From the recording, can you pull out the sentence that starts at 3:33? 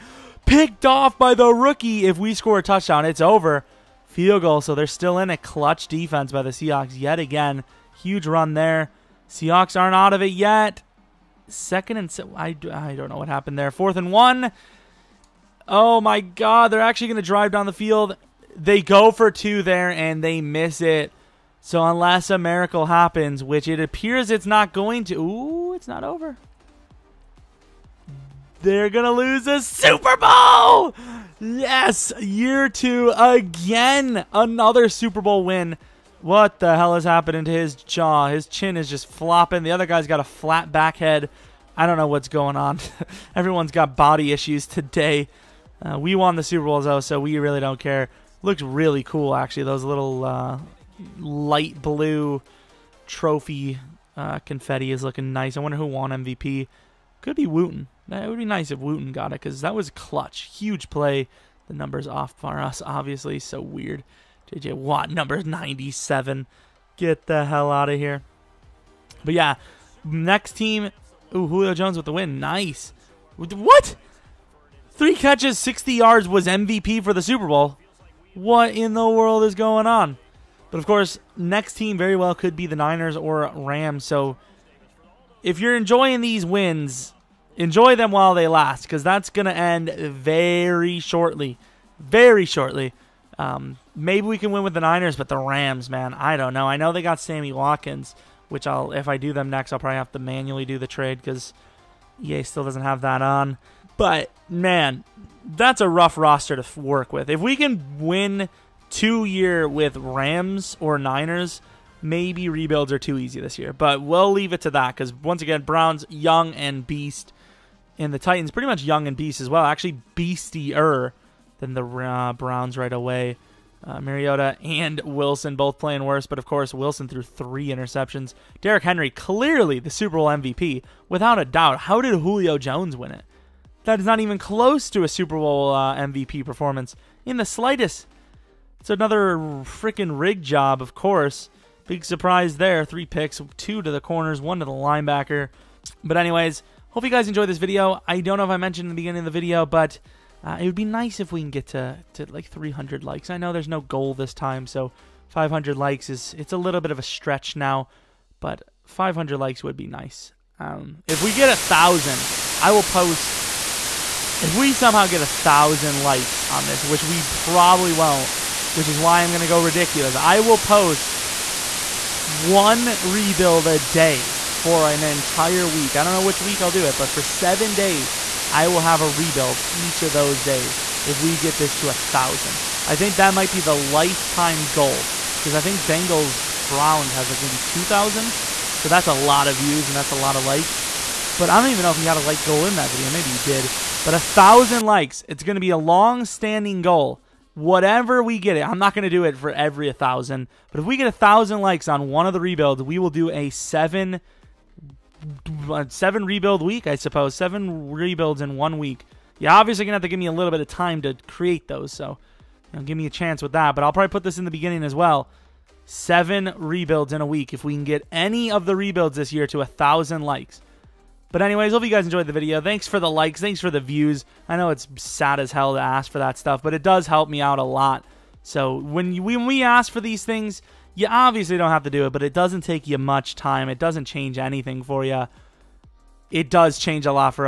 But I'll probably put this in the beginning as well.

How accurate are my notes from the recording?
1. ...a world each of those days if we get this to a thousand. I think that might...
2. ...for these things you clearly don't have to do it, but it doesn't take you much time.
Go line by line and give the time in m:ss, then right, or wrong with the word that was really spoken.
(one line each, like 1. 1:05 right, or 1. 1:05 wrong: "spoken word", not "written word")
1. 2:59 wrong: "rebuild", not "world"
2. 3:49 wrong: "obviously", not "clearly".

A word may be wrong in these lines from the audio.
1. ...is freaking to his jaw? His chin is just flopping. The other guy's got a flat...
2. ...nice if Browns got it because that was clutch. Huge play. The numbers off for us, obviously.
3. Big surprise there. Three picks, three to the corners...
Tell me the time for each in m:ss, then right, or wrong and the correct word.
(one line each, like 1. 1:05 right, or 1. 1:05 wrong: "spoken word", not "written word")
1. 0:36 wrong: "happening", not "freaking"
2. 0:58 wrong: "Wooten", not "Browns"
3. 2:21 wrong: "two", not "three".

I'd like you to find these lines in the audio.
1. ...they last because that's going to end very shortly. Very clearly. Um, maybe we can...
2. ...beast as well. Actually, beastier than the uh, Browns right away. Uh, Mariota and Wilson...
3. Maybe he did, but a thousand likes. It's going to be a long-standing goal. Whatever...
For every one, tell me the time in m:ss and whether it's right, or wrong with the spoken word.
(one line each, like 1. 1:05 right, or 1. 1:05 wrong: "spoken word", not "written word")
1. 1:28 wrong: "shortly", not "clearly"
2. 1:59 right
3. 3:13 right.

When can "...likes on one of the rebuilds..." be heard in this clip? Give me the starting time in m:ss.
3:21.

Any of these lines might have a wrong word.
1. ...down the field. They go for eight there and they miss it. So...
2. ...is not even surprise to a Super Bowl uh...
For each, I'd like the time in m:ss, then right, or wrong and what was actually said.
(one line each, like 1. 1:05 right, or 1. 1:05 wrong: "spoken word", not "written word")
1. 0:17 wrong: "two", not "eight"
2. 2:13 wrong: "close", not "surprise".